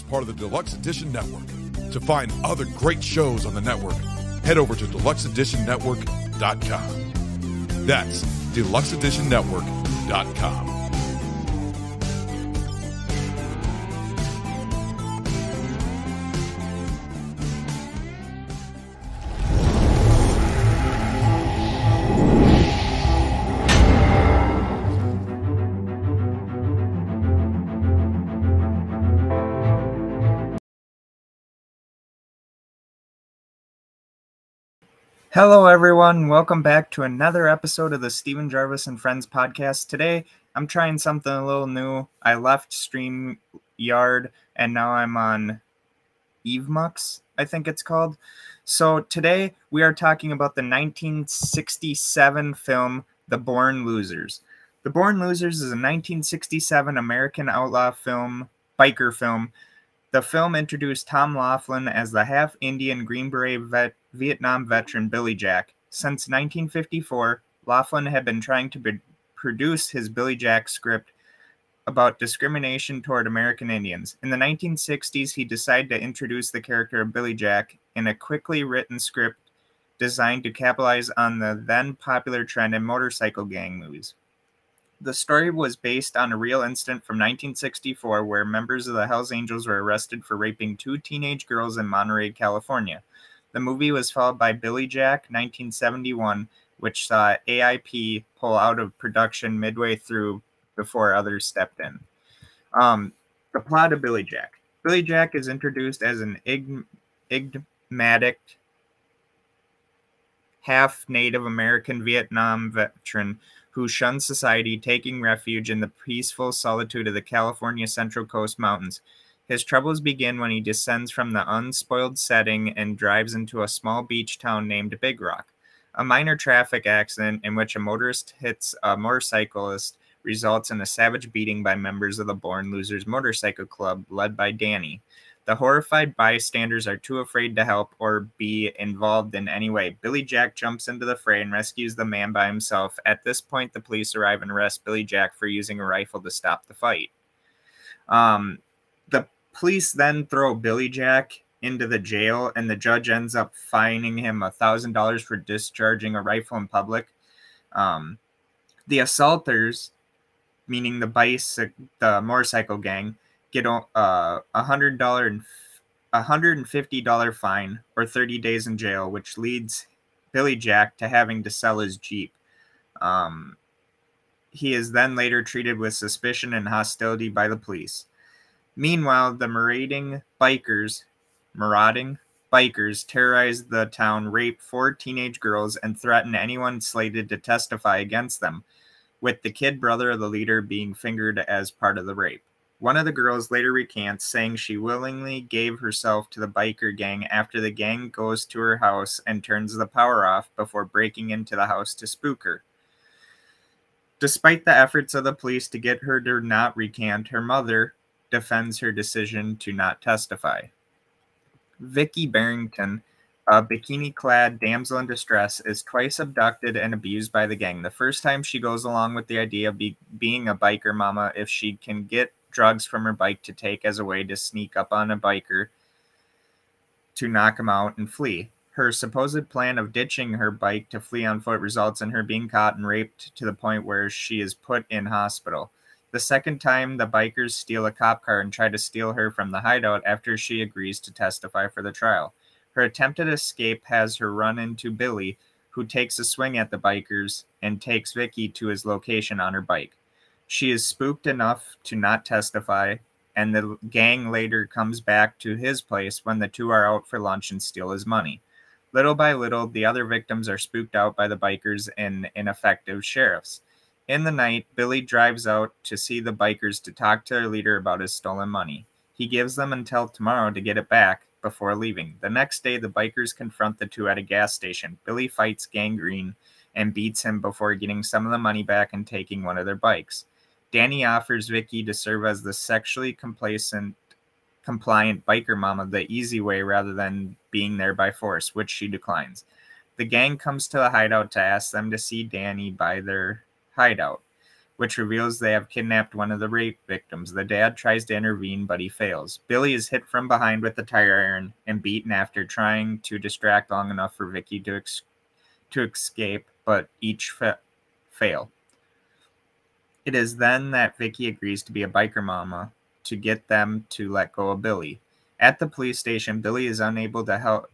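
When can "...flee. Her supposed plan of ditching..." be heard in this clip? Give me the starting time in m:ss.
3:48.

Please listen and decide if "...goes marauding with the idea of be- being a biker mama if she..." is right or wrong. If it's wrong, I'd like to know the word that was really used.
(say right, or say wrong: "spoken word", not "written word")
wrong: "along", not "marauding".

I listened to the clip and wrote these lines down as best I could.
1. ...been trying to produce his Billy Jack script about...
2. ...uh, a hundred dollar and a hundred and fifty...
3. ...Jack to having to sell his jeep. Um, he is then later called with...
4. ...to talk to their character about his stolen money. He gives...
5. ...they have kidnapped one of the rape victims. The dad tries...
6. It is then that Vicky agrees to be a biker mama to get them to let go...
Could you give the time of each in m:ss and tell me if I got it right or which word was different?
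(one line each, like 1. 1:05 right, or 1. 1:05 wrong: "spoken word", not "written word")
1. 1:08 right
2. 2:43 right
3. 2:50 wrong: "treated", not "called"
4. 4:26 wrong: "leader", not "character"
5. 4:55 right
6. 5:10 right.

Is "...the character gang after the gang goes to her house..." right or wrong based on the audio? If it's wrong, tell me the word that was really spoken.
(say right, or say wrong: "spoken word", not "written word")
wrong: "biker", not "character".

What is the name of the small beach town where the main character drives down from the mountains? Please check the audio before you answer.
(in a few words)
Big Rock.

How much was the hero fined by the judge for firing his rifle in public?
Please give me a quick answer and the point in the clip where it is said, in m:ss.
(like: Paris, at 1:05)
$1,000, at 2:34.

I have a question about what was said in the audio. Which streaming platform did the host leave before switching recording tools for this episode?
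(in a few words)
StreamYard.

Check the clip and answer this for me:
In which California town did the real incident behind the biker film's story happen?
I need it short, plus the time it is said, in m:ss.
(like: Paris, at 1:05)
Monterey, at 1:31.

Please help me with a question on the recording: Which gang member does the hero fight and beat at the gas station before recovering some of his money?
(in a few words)
Gangrene.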